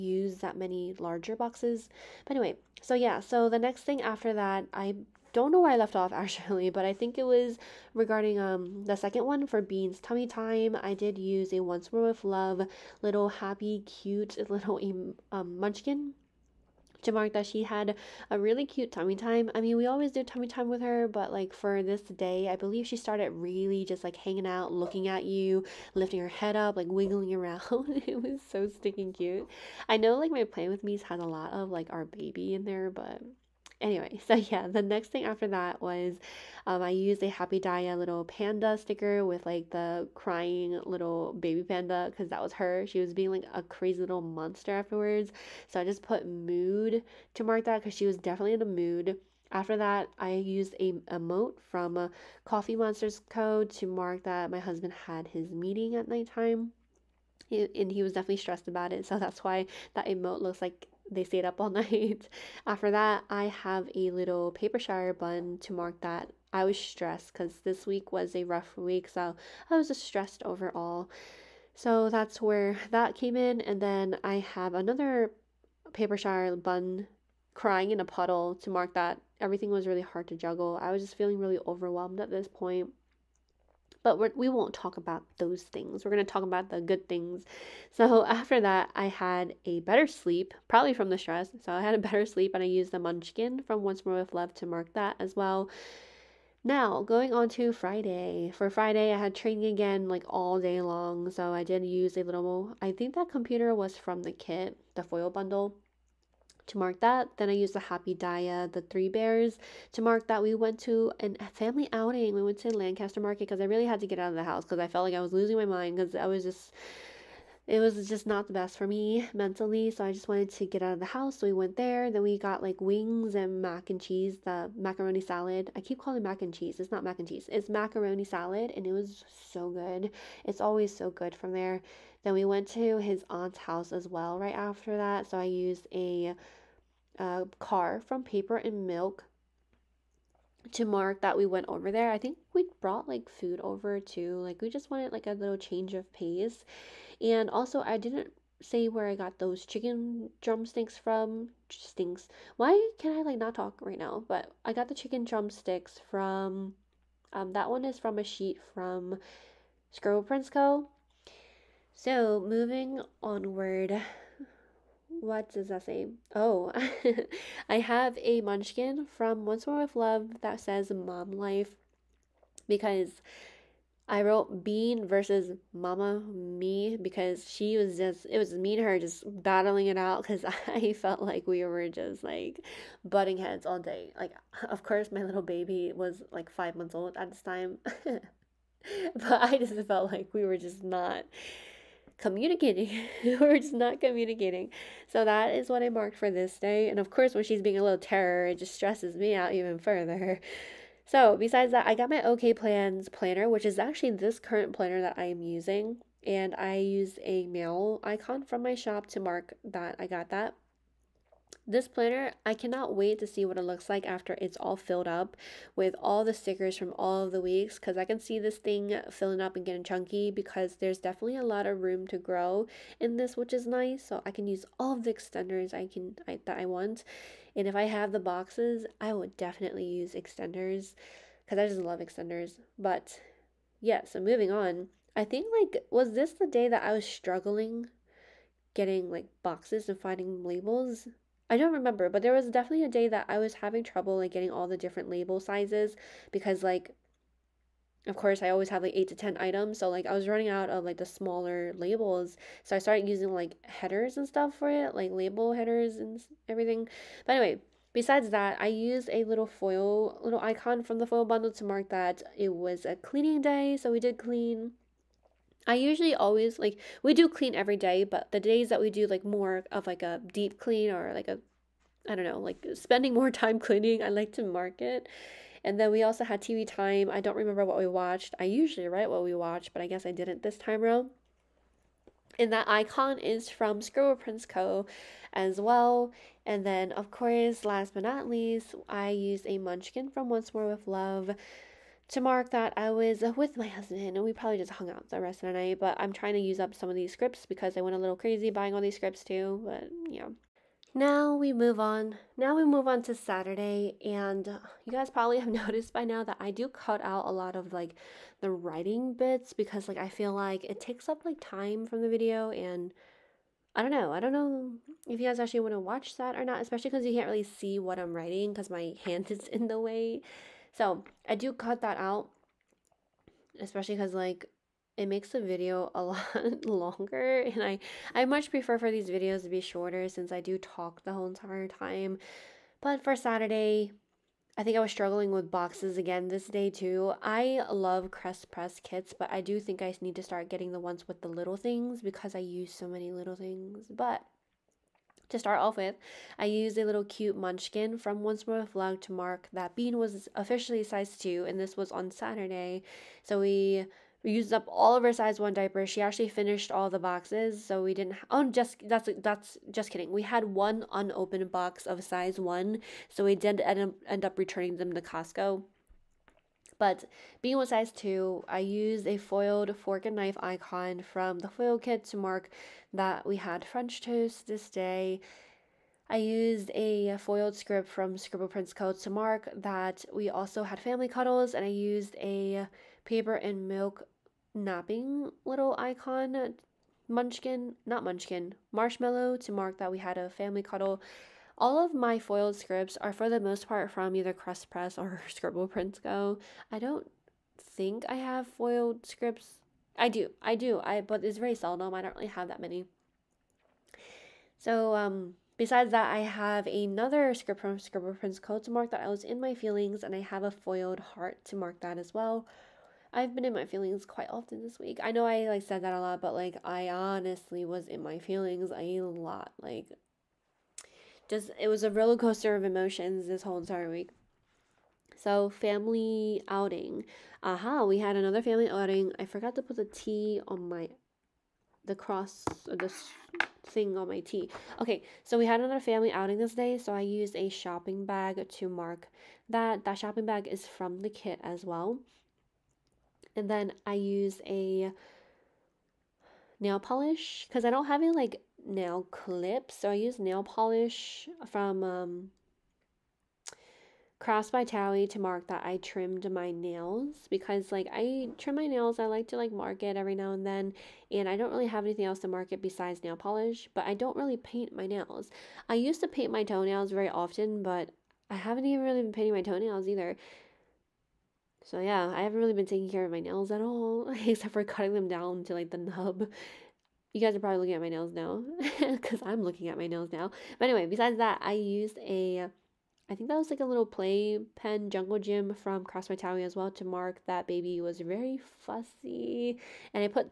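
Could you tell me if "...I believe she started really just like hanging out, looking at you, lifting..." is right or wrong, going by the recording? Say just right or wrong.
right.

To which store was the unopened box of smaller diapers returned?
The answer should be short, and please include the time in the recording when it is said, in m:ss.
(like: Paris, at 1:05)
Costco, at 6:04.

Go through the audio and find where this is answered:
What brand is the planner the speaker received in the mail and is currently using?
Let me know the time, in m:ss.
3:22.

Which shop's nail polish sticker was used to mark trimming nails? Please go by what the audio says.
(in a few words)
Crafts by Towie.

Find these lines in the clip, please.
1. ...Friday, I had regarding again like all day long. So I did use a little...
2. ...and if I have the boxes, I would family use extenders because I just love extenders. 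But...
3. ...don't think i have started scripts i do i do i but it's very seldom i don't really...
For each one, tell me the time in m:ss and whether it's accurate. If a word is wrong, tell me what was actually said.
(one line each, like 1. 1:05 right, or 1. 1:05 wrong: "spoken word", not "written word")
1. 1:38 wrong: "training", not "regarding"
2. 3:47 wrong: "definitely", not "family"
3. 6:36 wrong: "foiled", not "started".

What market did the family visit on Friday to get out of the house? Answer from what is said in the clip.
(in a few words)
Lancaster Market.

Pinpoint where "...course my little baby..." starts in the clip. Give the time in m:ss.
3:04.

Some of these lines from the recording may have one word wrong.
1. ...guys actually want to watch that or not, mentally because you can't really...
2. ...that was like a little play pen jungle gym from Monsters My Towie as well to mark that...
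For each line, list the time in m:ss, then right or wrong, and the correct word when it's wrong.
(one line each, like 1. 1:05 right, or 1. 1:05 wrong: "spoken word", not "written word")
1. 5:15 wrong: "especially", not "mentally"
2. 8:03 wrong: "Cross", not "Monsters".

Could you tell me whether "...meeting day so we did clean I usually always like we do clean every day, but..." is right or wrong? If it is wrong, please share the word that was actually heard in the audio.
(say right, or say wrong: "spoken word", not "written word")
wrong: "cleaning", not "meeting".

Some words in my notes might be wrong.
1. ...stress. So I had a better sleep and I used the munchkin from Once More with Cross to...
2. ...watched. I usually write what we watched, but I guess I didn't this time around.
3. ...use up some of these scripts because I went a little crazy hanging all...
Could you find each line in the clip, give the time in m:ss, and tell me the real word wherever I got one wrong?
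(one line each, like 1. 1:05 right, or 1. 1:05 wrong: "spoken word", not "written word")
1. 1:31 wrong: "Love", not "Cross"
2. 4:37 right
3. 4:56 wrong: "buying", not "hanging".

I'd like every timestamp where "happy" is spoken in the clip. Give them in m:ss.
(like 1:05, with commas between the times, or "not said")
0:13, 0:37, 1:47.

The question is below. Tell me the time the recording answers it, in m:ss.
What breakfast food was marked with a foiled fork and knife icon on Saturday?
6:13.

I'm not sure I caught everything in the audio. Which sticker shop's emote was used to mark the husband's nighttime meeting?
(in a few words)
Coffee Monsters Co.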